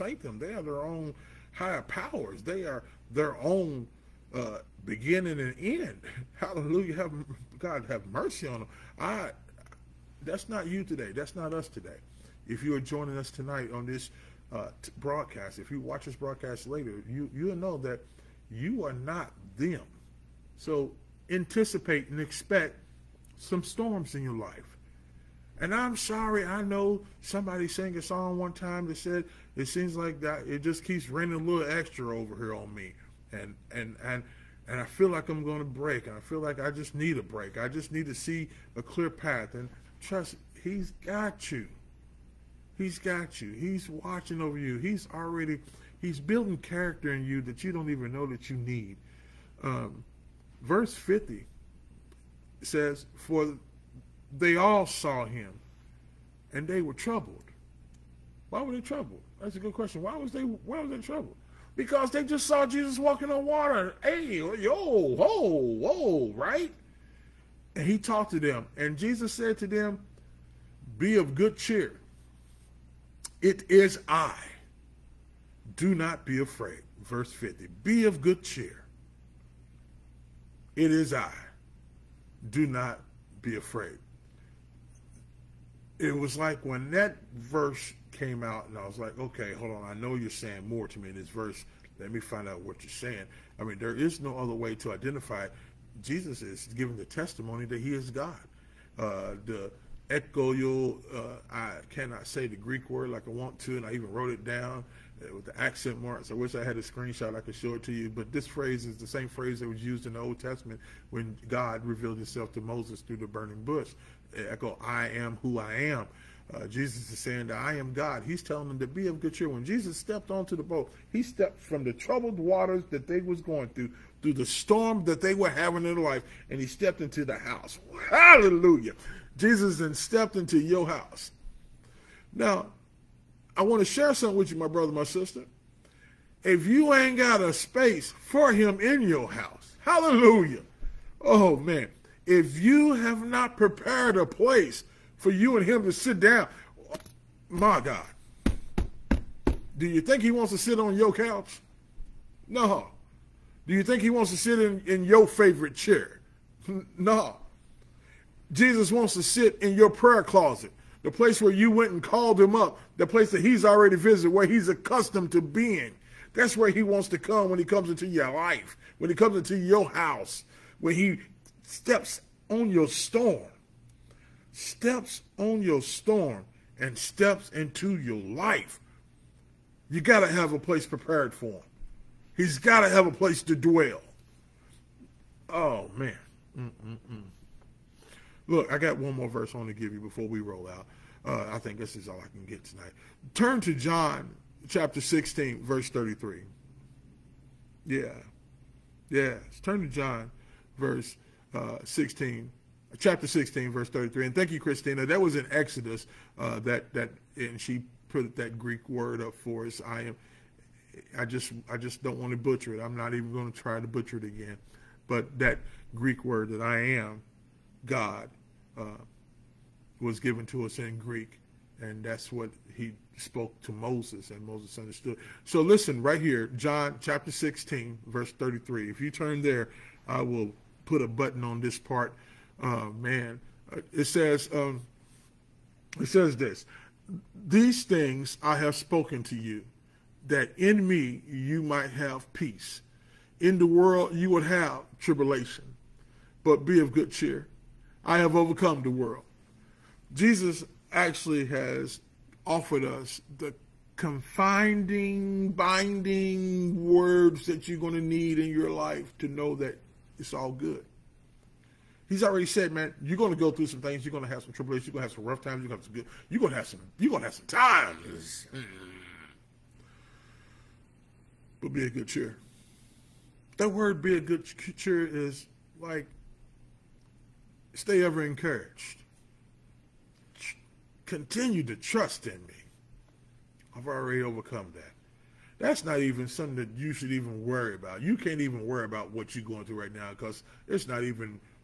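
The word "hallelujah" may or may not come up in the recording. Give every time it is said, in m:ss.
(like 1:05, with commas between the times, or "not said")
0:06, 2:08, 2:19.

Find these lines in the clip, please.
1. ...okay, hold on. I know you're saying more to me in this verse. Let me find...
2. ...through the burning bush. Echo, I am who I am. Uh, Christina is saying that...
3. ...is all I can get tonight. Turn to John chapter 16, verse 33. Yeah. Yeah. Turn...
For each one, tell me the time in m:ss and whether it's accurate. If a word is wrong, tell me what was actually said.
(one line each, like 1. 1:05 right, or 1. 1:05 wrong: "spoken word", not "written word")
1. 1:29 right
2. 1:52 wrong: "Jesus", not "Christina"
3. 3:11 right.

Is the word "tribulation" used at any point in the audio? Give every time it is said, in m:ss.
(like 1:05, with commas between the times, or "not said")
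4:04, 4:24.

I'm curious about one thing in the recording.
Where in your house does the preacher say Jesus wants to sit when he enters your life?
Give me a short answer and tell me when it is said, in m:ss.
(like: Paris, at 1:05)
prayer closet, at 2:39.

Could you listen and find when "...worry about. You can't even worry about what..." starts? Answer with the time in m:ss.
4:47.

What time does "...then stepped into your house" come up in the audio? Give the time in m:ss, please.
2:09.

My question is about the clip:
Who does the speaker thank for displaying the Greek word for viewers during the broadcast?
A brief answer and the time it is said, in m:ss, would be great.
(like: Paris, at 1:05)
Christina, at 3:24.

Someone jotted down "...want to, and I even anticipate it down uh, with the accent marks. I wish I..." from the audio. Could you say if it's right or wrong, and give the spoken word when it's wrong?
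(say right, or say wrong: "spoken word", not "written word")
wrong: "wrote", not "anticipate".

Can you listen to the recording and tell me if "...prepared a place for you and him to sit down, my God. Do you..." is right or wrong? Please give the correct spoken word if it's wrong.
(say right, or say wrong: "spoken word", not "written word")
right.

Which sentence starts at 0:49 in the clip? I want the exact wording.
Um, verse 50 it says, For they all saw him and they were troubled.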